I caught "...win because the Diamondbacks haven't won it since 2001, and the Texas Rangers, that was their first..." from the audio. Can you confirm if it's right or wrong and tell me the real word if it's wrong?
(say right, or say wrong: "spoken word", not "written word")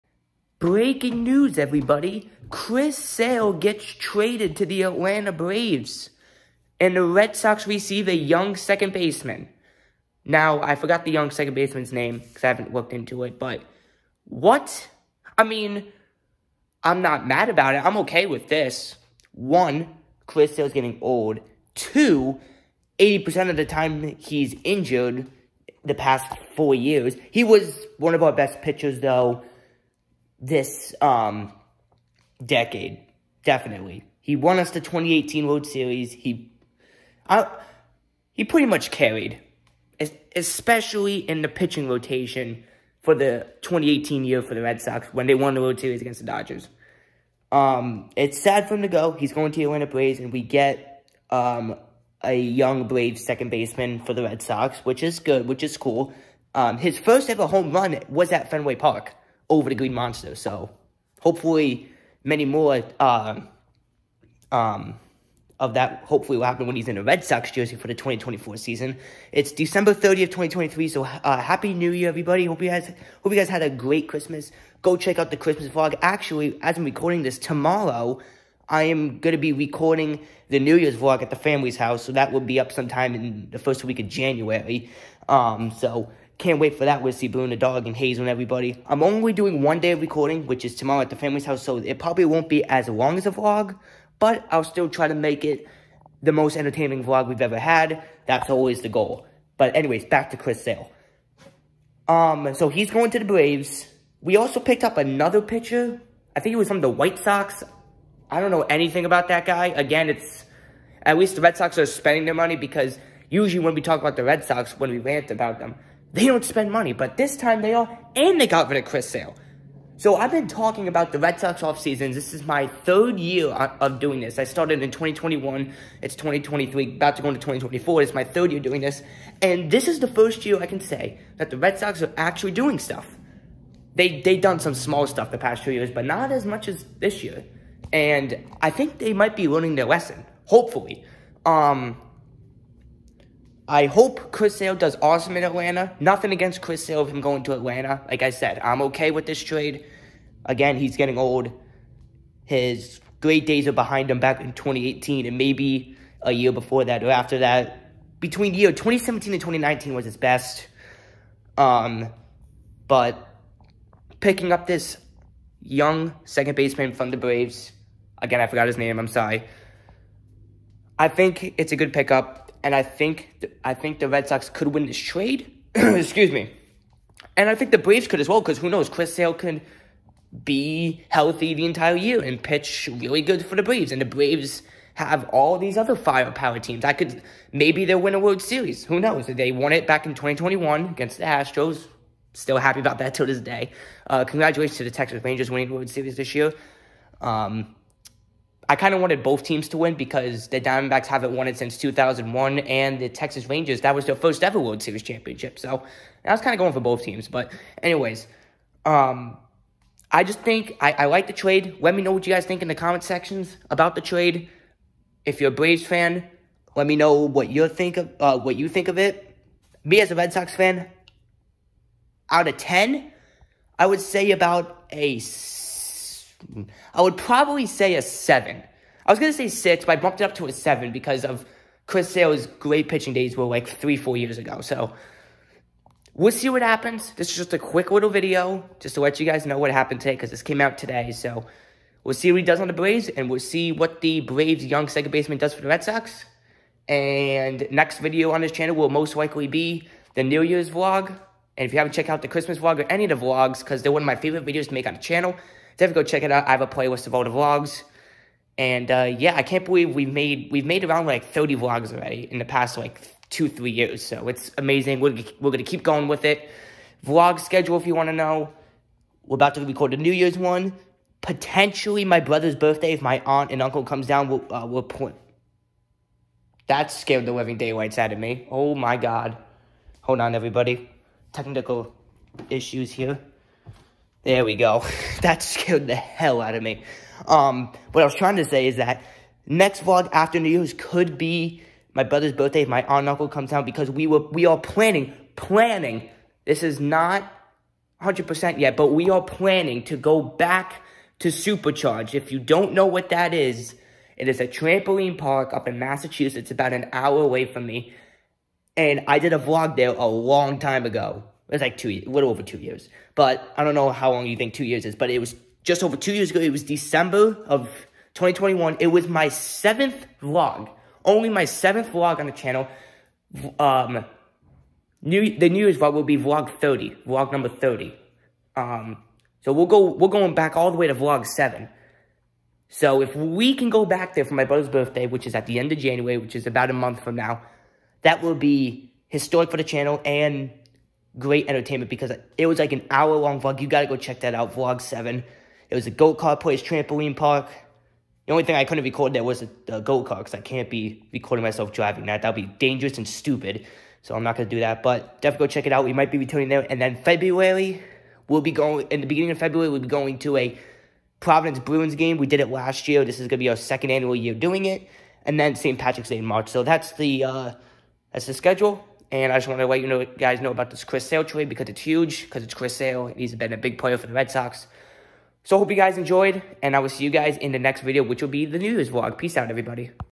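right.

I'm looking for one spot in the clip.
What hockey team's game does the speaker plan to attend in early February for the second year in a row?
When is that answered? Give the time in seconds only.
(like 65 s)
361 s.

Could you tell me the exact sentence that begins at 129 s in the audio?
And this is the first year I can say that the Red Sox are actually doing stuff.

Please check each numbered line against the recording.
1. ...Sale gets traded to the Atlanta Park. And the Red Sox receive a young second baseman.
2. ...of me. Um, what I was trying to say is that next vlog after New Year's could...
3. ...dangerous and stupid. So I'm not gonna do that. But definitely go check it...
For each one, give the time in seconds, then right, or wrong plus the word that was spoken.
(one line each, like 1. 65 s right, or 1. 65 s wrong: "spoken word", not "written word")
1. 2 s wrong: "Braves", not "Park"
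2. 286 s right
3. 352 s right.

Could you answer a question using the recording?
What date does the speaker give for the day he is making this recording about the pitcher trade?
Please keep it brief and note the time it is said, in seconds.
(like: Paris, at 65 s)
December 30th, 2023, at 69 s.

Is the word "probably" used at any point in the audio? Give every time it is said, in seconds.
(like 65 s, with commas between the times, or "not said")
91 s, 227 s.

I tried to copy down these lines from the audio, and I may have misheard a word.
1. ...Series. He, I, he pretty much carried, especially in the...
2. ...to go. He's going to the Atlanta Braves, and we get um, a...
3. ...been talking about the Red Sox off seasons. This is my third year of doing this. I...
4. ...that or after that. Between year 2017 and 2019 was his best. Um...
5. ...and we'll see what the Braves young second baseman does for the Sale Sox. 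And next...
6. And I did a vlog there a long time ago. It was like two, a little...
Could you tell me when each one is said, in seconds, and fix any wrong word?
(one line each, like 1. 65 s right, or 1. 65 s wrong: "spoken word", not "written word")
1. 35 s right
2. 48 s right
3. 120 s right
4. 156 s right
5. 243 s wrong: "Red", not "Sale"
6. 308 s right.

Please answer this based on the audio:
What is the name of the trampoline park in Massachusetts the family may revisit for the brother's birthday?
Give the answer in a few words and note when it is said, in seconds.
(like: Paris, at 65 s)
Supercharge, at 301 s.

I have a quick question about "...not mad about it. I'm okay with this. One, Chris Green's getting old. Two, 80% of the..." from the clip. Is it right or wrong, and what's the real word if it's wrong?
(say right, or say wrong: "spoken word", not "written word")
wrong: "Sale", not "Green".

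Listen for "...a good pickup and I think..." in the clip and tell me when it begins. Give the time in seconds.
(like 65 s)
171 s.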